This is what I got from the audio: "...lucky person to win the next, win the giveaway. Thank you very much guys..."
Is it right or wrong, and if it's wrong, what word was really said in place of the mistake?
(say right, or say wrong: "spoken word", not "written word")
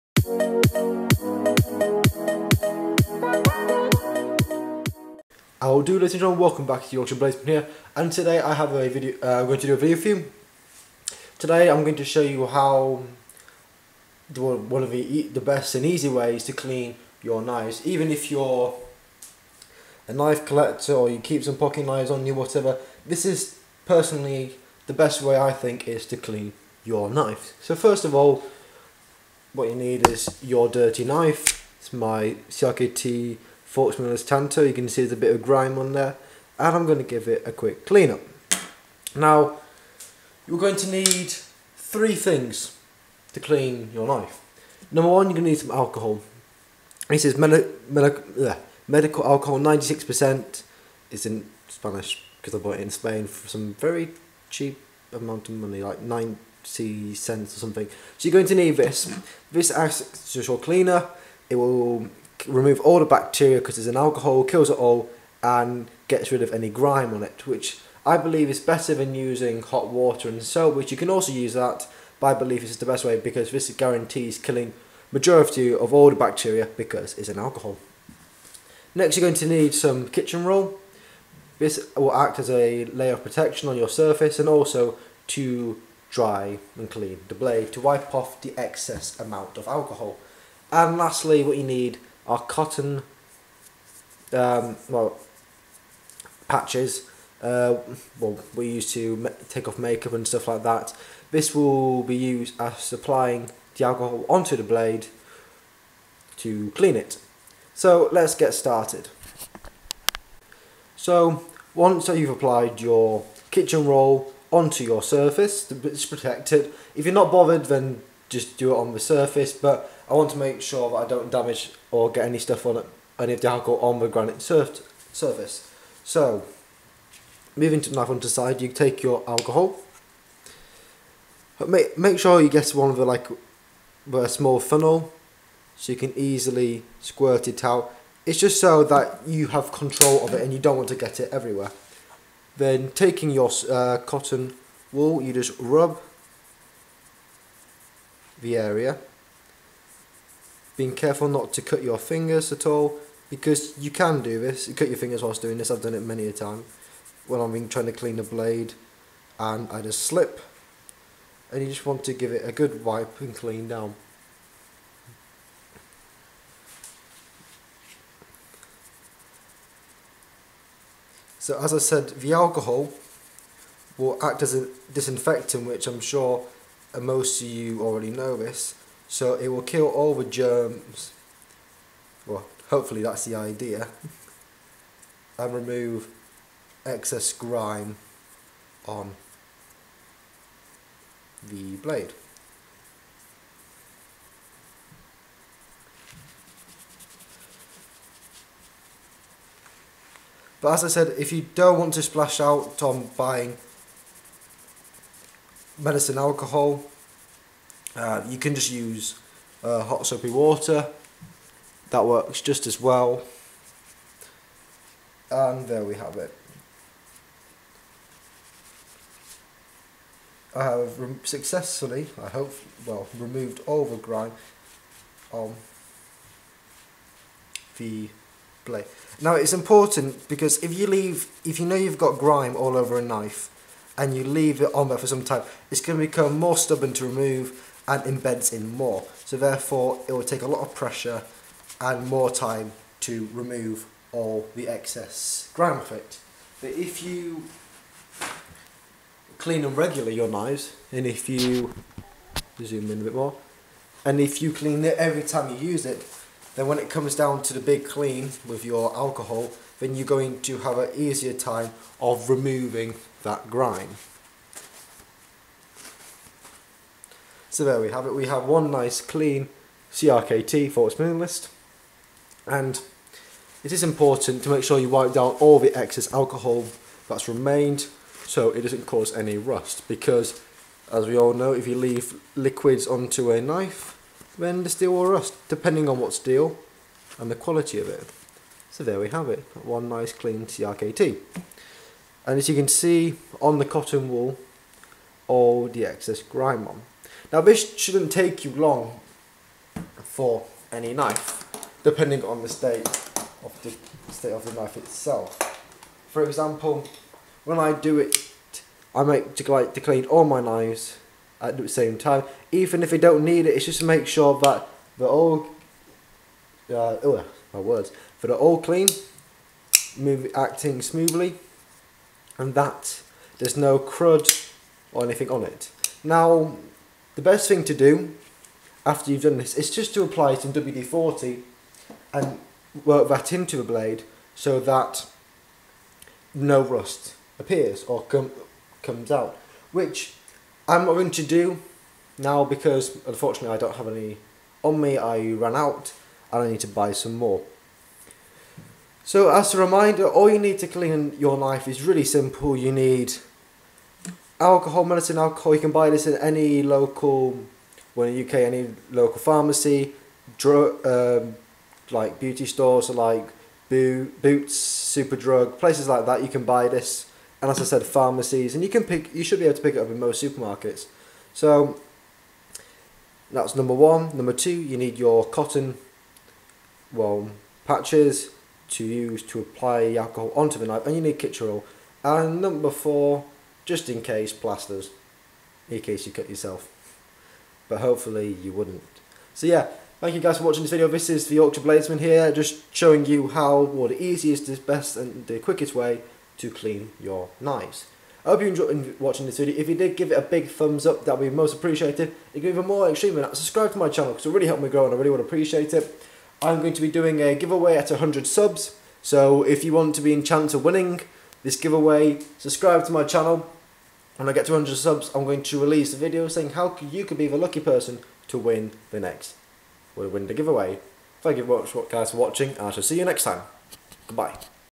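right.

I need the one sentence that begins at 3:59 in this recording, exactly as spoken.
So therefore it will take a lot of pressure and more time to remove all the excess grime off it.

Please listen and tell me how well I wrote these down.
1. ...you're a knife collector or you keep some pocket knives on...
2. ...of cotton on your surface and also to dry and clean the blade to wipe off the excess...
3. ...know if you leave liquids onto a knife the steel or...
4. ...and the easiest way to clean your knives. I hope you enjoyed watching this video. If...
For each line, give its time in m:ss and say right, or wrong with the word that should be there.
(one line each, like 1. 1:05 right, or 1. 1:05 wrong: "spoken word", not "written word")
1. 0:18 right
2. 1:23 wrong: "protection", not "cotton"
3. 4:41 right
4. 6:34 wrong: "quickest", not "easiest".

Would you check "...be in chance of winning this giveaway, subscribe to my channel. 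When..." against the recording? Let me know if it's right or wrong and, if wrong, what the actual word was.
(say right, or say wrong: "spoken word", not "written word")
right.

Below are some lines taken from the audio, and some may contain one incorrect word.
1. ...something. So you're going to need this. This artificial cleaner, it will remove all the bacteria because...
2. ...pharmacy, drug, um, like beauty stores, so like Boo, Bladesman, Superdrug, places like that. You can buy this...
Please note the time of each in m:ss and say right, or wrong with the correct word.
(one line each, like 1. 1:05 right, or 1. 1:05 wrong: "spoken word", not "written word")
1. 0:57 right
2. 5:59 wrong: "Boots", not "Bladesman".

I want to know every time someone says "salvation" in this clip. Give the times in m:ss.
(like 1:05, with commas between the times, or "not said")
not said.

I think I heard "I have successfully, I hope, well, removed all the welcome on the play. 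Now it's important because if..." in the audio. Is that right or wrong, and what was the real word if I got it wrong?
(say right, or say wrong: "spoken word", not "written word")
wrong: "grime", not "welcome".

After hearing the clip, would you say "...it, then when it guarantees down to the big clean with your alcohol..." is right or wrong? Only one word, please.
wrong.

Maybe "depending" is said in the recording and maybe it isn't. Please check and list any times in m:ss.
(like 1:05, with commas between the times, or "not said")
4:45, 5:01.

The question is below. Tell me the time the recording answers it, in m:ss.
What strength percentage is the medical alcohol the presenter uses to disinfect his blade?
0:49.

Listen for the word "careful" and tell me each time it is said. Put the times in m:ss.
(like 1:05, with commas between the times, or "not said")
2:30.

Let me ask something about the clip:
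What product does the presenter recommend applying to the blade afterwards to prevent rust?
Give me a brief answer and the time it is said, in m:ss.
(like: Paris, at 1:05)
WD-40, at 5:30.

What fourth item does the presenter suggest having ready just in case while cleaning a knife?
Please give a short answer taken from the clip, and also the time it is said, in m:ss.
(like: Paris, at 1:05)
Plasters, at 6:24.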